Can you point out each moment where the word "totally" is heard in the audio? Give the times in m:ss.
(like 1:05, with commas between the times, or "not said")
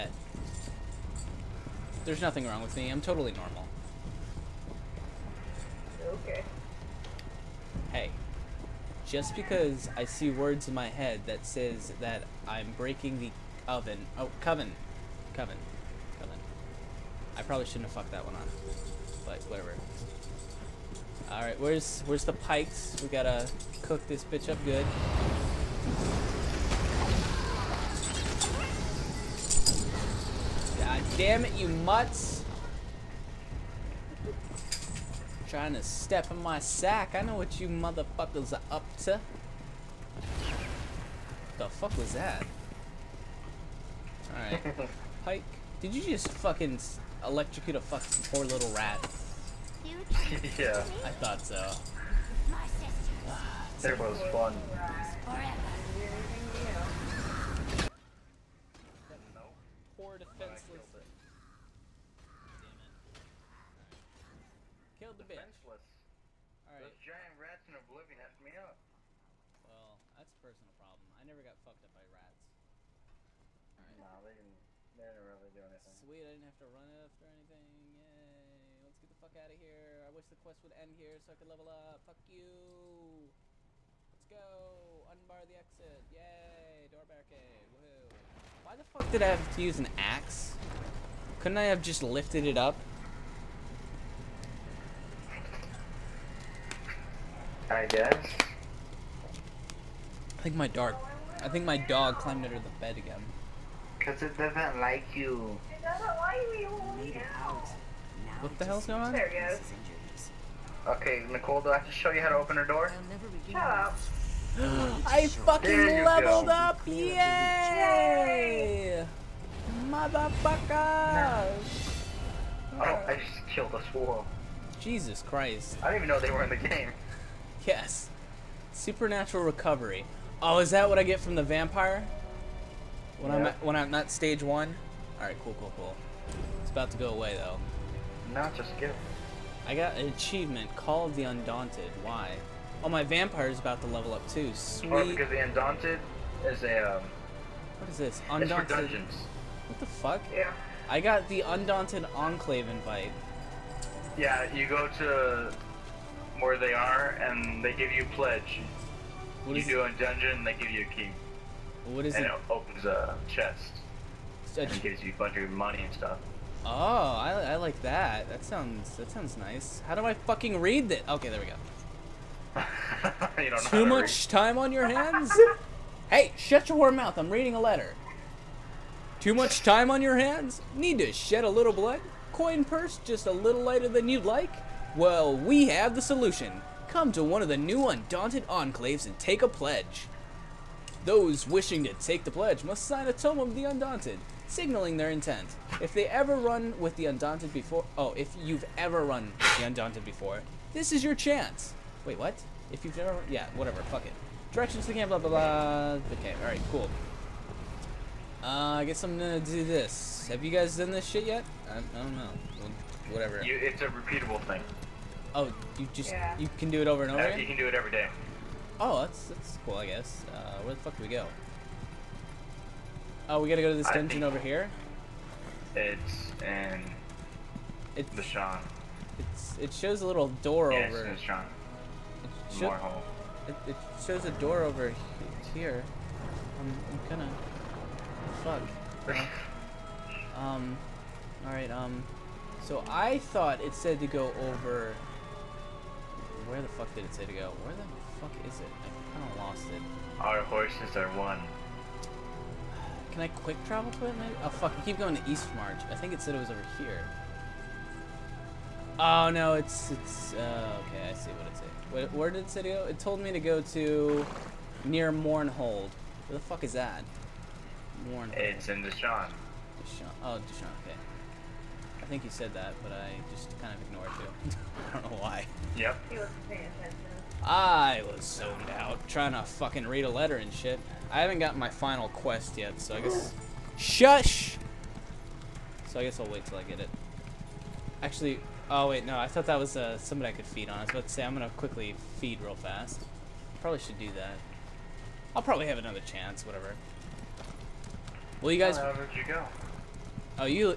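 0:03.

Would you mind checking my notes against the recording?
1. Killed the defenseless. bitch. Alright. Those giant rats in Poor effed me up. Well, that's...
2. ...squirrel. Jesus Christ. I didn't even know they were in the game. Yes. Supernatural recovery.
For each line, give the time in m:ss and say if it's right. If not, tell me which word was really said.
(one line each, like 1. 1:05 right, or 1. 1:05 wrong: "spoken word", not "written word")
1. 1:04 wrong: "Oblivion", not "Poor"
2. 2:03 right.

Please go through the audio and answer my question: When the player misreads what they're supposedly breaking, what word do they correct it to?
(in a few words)
coven.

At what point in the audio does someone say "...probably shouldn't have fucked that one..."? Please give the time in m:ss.
0:17.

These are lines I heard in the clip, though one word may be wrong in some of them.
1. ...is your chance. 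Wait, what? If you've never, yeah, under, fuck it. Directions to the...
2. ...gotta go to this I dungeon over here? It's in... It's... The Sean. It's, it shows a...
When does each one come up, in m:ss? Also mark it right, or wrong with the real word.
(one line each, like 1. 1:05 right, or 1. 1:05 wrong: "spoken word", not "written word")
1. 3:20 wrong: "whatever", not "under"
2. 3:43 right.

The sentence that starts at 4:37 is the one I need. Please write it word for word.
I was zoned out, trying to fucking read a letter and shit.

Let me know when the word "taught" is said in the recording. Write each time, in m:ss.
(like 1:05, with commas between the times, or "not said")
not said.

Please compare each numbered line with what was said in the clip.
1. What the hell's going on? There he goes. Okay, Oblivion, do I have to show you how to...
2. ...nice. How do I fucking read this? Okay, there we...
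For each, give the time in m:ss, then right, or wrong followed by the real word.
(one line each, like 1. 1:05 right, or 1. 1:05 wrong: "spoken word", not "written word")
1. 1:48 wrong: "Nicole", not "Oblivion"
2. 2:49 right.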